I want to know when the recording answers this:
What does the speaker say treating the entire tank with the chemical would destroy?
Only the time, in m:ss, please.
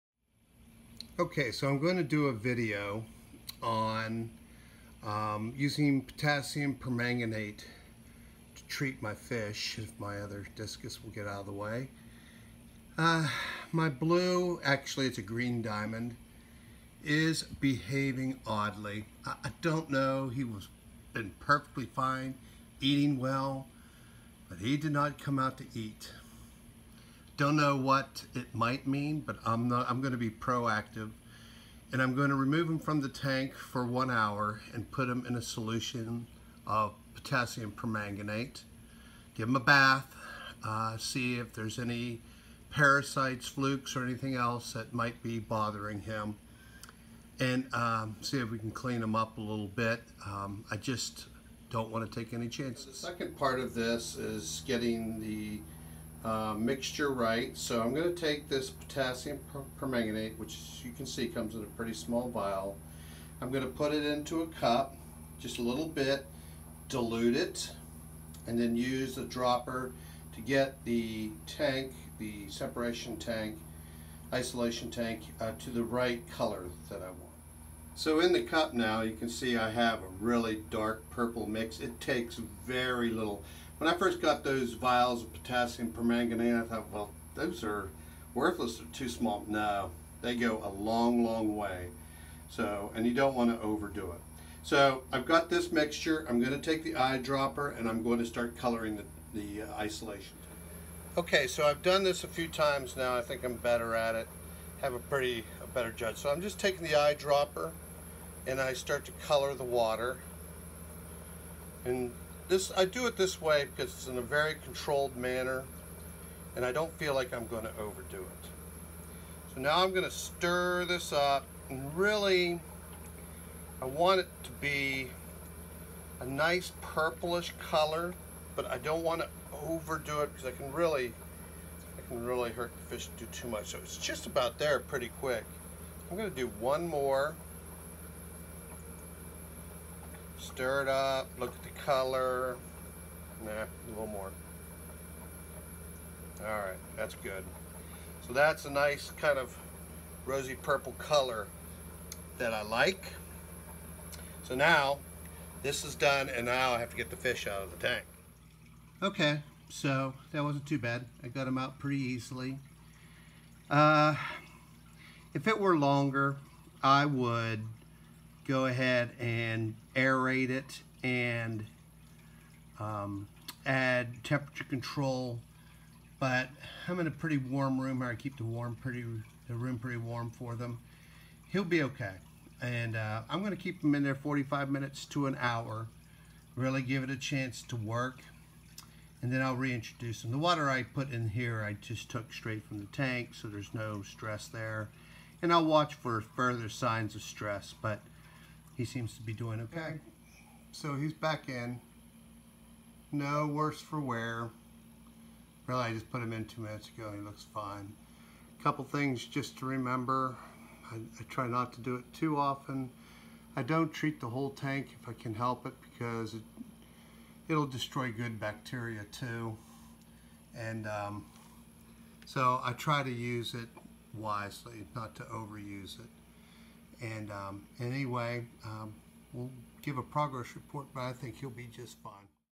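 3:38.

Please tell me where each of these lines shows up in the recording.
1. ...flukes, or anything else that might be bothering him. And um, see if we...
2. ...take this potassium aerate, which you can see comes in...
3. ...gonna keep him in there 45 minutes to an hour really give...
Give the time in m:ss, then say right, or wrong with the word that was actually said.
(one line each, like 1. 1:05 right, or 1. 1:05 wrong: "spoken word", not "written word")
1. 0:43 right
2. 0:58 wrong: "permanganate", not "aerate"
3. 3:03 right.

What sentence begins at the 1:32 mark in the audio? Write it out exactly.
So, and you don't want to overdo it.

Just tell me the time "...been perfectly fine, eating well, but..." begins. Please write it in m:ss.
0:21.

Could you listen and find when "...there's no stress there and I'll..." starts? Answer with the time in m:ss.
3:13.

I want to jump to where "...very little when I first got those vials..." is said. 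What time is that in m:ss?
1:22.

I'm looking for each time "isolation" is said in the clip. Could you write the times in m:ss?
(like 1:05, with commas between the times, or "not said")
1:14, 1:39.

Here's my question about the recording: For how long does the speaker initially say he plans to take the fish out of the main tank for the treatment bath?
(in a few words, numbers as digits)
1 hour.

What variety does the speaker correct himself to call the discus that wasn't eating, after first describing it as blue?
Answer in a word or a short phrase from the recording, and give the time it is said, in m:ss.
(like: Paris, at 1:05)
green diamond, at 0:15.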